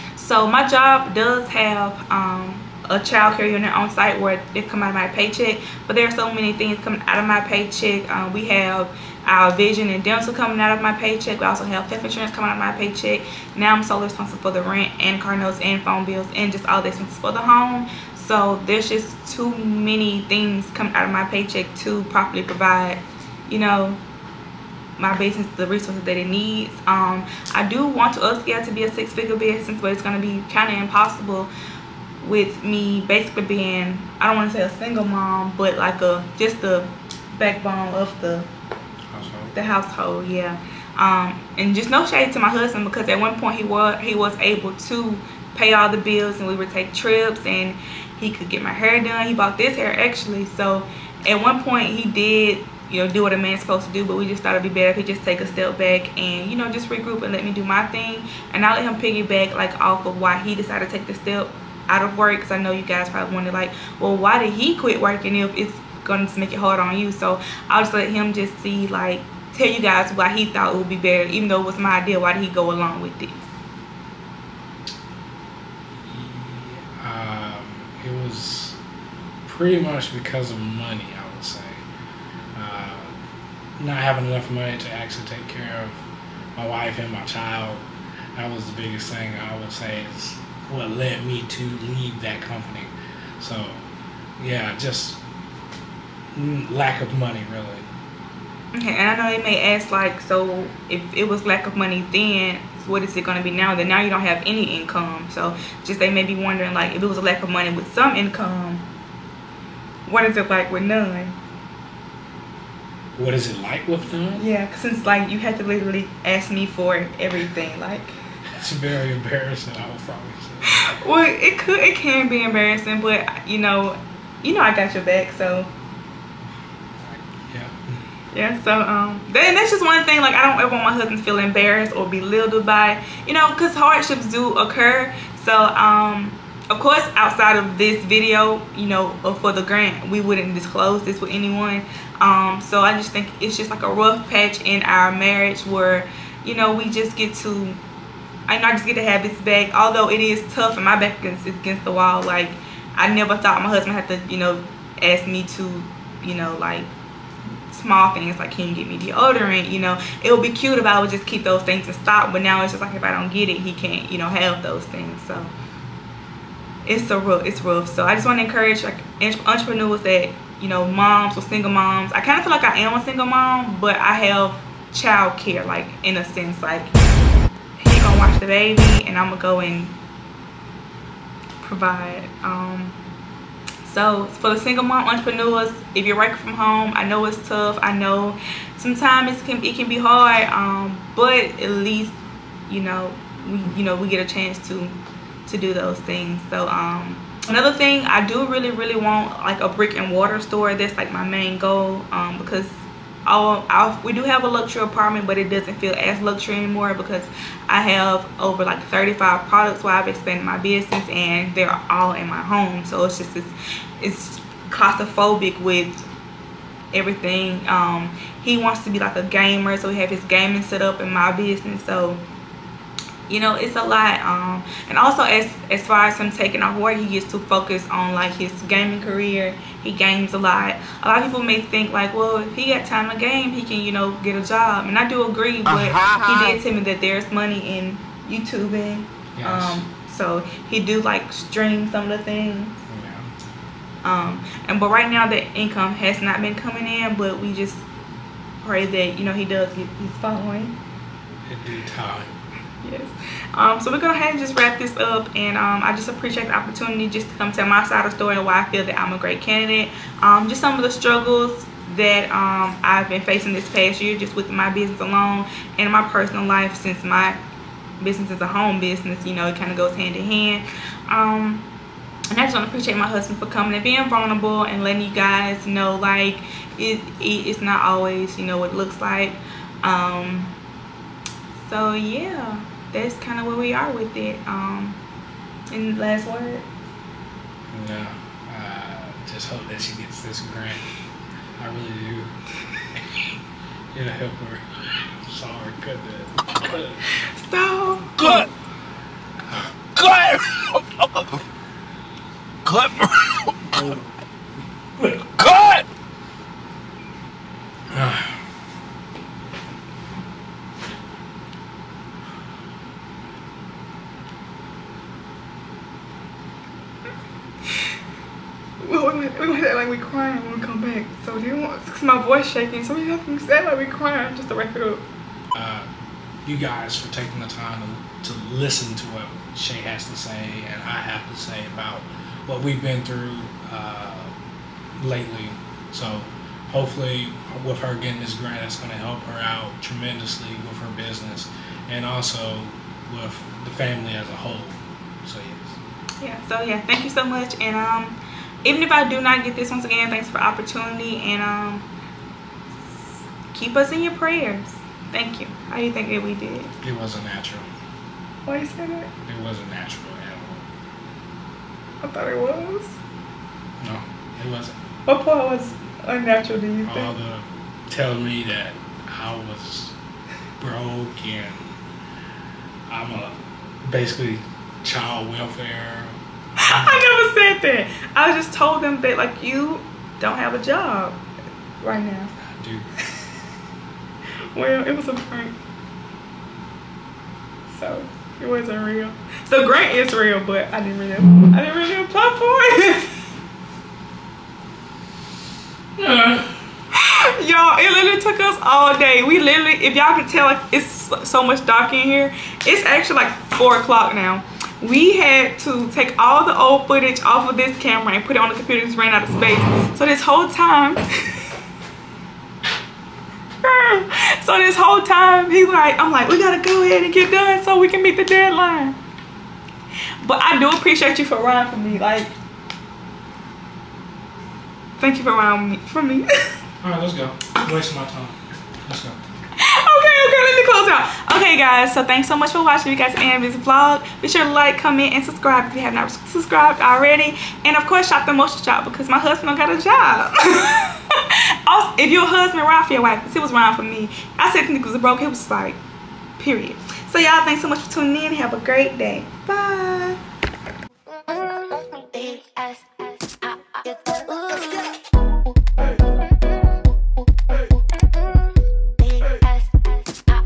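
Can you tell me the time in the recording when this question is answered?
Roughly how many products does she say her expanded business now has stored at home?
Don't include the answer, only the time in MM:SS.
03:28.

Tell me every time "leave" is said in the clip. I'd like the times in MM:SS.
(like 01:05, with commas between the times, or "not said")
01:31.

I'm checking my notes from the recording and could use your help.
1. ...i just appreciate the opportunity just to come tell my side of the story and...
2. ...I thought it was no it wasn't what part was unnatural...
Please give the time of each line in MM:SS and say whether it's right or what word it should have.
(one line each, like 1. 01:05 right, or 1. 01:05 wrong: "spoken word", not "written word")
1. 04:15 right
2. 06:02 right.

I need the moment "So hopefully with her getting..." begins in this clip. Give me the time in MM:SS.
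05:35.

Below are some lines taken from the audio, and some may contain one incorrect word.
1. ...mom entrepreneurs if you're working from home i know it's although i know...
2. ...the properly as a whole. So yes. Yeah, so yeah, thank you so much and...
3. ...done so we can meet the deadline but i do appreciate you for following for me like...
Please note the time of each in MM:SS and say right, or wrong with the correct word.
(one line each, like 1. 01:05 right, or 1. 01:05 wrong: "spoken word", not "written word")
1. 03:04 wrong: "tough", not "although"
2. 05:43 wrong: "family", not "properly"
3. 06:57 wrong: "riding", not "following".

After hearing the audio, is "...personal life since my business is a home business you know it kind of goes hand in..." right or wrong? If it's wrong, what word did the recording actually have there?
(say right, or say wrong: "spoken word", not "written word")
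right.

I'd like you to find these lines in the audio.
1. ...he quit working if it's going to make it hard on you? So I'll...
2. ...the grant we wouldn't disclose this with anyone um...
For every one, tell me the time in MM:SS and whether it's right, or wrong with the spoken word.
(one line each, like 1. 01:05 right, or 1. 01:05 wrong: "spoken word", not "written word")
1. 01:04 right
2. 02:19 right.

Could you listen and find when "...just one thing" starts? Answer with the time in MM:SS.
02:09.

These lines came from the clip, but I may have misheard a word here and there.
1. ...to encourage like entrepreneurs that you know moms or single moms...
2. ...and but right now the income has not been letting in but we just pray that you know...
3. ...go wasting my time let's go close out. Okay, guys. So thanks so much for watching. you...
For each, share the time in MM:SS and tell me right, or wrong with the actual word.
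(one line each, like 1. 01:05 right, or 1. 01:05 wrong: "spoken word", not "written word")
1. 02:48 right
2. 04:04 wrong: "coming", not "letting"
3. 07:07 right.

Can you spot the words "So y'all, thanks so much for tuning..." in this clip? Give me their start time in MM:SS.
07:27.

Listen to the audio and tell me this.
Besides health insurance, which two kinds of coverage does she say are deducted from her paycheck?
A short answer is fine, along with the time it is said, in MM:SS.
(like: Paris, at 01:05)
Vision and dental, at 00:09.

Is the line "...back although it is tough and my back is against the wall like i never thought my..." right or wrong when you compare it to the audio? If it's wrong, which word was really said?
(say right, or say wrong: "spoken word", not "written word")
right.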